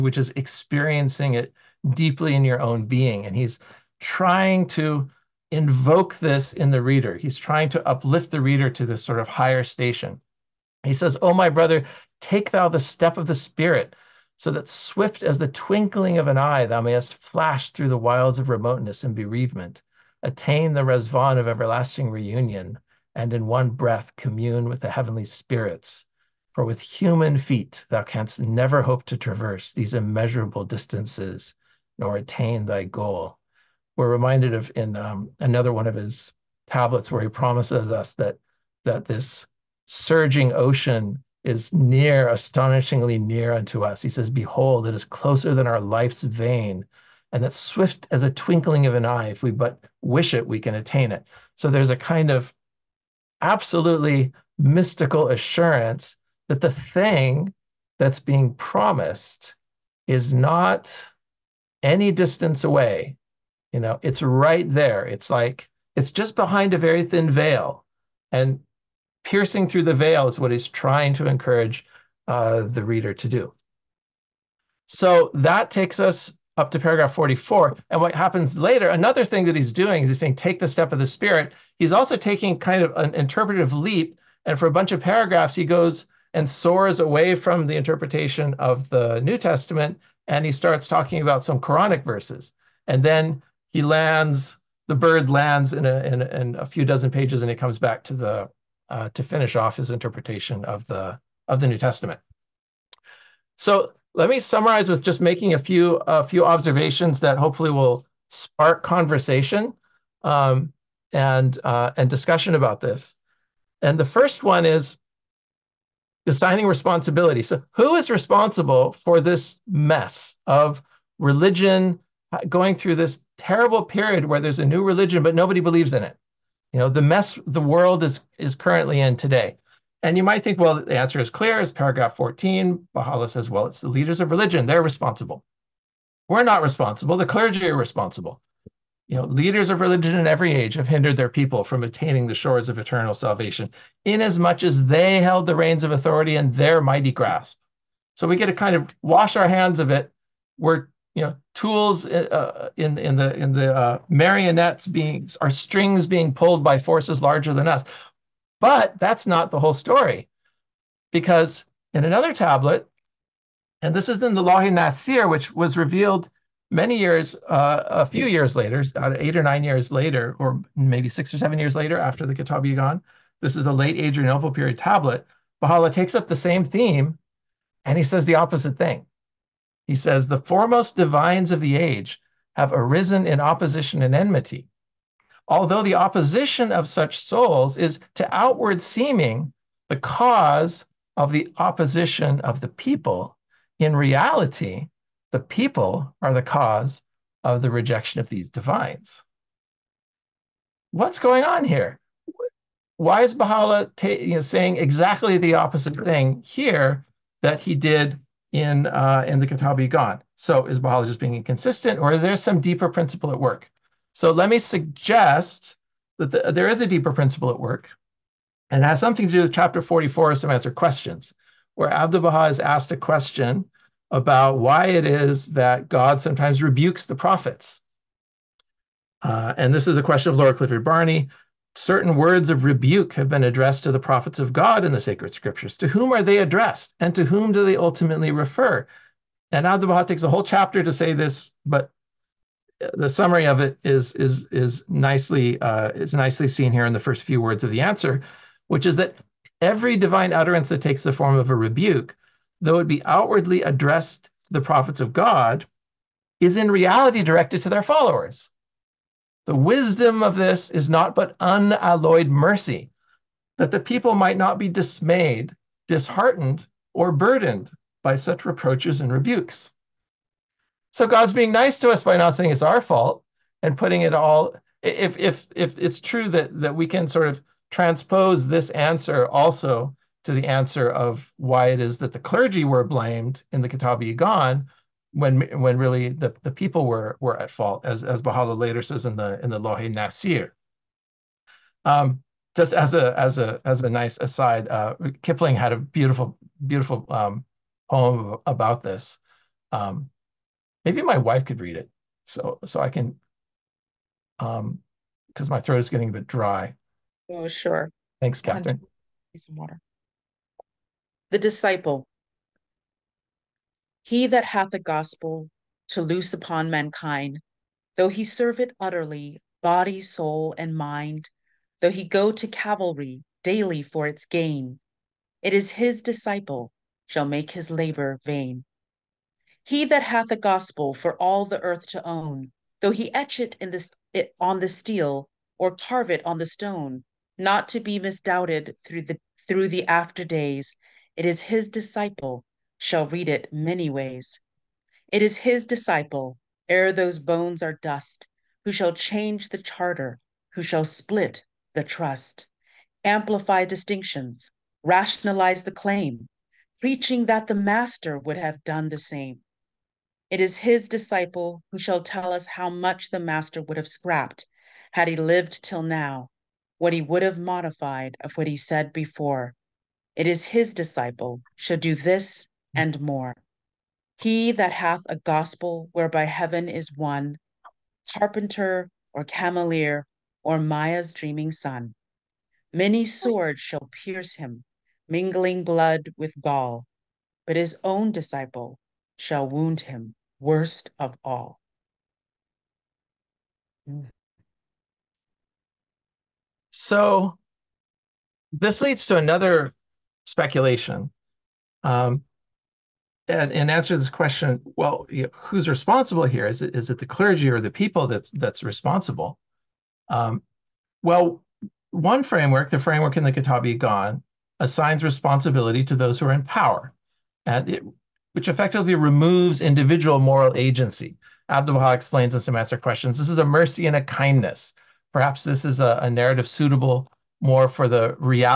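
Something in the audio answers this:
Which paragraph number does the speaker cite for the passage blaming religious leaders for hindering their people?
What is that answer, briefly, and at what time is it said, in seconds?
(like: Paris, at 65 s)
14, at 131 s.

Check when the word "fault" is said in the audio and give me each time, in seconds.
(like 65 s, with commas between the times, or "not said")
272 s, 287 s.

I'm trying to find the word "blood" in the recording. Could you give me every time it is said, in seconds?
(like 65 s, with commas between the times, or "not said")
385 s.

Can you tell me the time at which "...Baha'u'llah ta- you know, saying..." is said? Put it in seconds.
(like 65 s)
203 s.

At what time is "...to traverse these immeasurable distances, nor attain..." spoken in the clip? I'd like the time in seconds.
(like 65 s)
29 s.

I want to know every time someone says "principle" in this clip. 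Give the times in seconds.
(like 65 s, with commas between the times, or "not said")
212 s, 217 s.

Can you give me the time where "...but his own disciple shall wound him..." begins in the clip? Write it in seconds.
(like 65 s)
387 s.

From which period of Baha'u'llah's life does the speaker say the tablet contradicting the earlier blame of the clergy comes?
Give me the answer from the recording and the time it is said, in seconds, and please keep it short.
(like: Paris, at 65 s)
Late Adrianople period, at 173 s.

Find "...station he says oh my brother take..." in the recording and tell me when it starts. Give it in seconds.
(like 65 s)
9 s.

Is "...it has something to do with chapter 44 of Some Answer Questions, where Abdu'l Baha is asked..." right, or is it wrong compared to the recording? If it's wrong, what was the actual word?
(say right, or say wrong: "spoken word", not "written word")
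right.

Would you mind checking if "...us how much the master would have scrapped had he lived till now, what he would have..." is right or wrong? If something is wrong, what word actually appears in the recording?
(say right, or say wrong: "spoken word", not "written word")
right.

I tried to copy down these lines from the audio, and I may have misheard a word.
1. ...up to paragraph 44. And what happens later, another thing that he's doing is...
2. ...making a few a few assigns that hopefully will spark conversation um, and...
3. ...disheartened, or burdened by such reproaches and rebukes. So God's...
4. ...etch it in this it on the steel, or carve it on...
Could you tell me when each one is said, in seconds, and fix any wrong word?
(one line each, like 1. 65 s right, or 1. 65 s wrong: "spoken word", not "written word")
1. 76 s right
2. 105 s wrong: "observations", not "assigns"
3. 265 s right
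4. 333 s right.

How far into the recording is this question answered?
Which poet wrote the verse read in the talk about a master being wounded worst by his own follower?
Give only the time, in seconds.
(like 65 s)
295 s.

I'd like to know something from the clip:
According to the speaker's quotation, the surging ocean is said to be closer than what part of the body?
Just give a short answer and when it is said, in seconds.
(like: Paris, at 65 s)
Life's vein, at 45 s.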